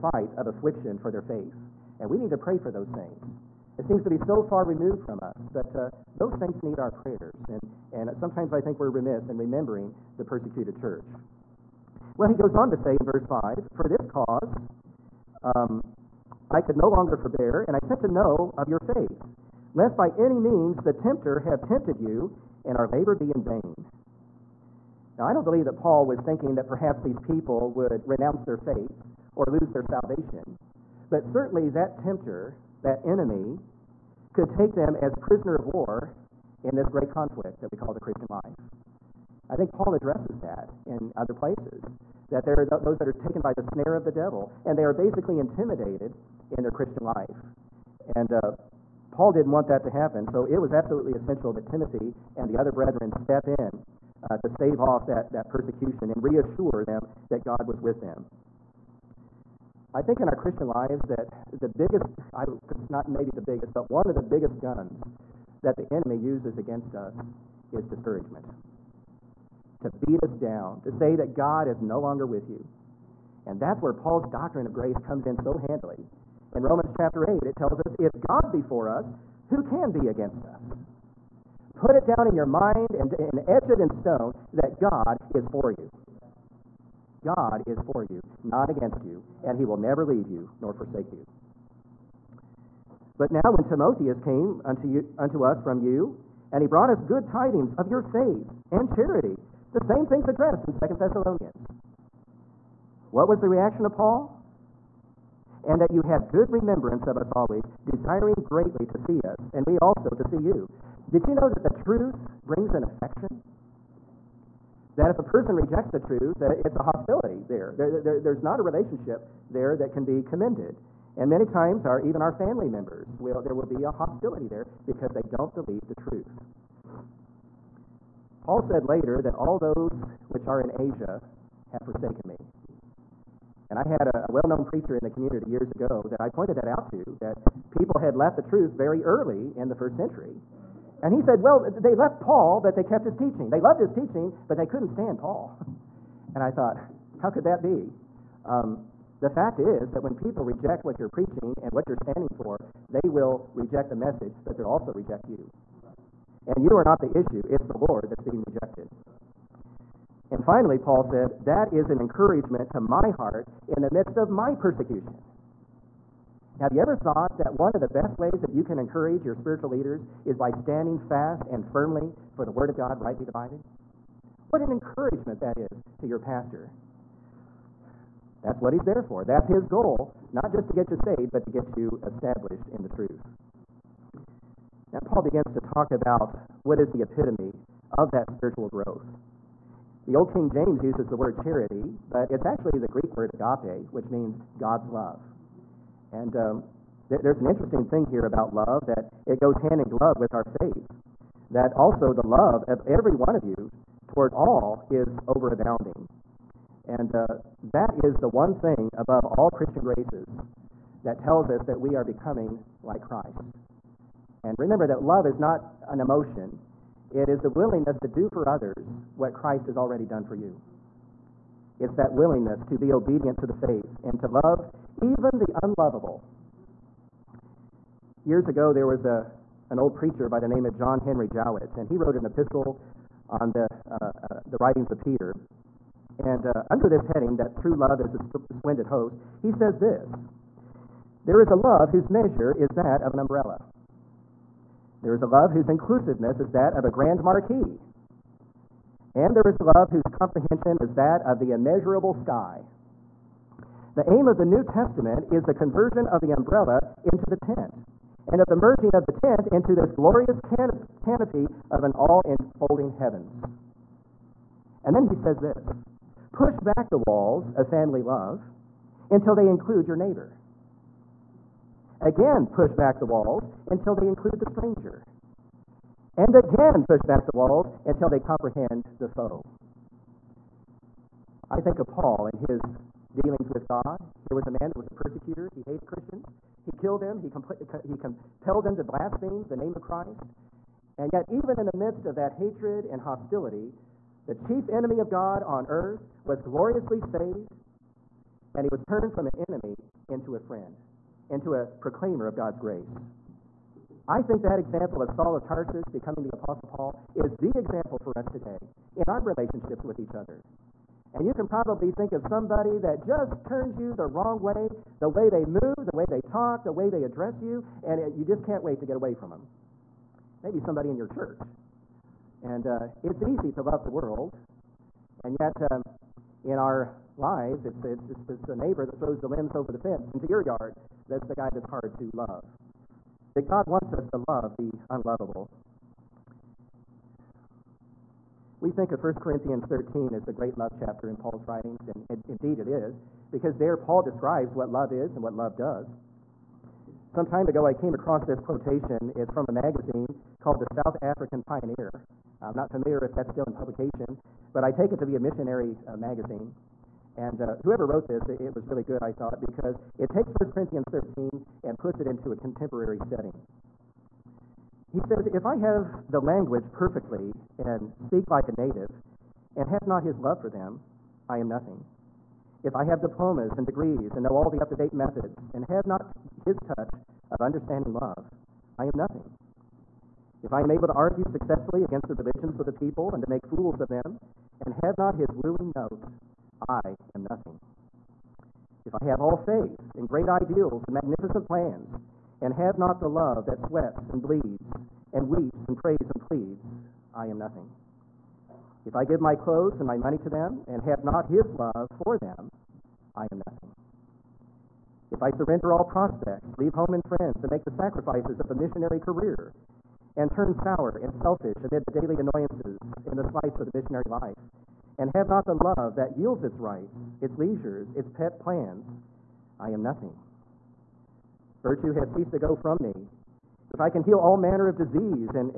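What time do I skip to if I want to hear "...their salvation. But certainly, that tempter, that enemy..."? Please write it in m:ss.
0:29.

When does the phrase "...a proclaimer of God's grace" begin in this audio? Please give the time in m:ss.
5:01.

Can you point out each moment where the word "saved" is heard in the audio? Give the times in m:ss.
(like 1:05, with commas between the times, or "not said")
3:00, 4:56.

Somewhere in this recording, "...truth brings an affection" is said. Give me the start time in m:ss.
1:51.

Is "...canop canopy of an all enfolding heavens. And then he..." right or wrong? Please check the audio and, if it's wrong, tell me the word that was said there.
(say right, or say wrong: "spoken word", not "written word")
right.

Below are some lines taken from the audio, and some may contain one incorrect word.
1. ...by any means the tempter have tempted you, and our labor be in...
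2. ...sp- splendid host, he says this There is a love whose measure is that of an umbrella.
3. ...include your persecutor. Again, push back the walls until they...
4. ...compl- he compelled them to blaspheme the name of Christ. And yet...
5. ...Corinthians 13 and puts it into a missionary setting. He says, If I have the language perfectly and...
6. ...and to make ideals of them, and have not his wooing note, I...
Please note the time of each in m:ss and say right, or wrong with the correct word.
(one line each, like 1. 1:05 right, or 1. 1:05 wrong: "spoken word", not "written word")
1. 0:19 right
2. 3:58 right
3. 4:29 wrong: "neighbor", not "persecutor"
4. 4:47 right
5. 6:00 wrong: "contemporary", not "missionary"
6. 6:23 wrong: "fools", not "ideals".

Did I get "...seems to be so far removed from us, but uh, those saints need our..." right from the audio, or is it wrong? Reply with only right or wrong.
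right.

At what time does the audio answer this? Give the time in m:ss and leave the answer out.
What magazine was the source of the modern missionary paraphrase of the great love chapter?
5:50.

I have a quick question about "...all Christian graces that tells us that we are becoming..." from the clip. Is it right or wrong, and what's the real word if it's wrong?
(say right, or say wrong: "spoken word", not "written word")
right.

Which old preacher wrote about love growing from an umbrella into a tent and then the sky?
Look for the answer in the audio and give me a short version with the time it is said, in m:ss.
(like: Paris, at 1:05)
John Henry Jowett, at 3:50.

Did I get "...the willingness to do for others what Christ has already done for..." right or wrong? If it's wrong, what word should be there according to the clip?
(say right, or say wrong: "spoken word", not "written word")
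right.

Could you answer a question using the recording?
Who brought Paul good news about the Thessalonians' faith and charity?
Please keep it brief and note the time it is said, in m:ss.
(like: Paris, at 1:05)
Timotheus, at 1:33.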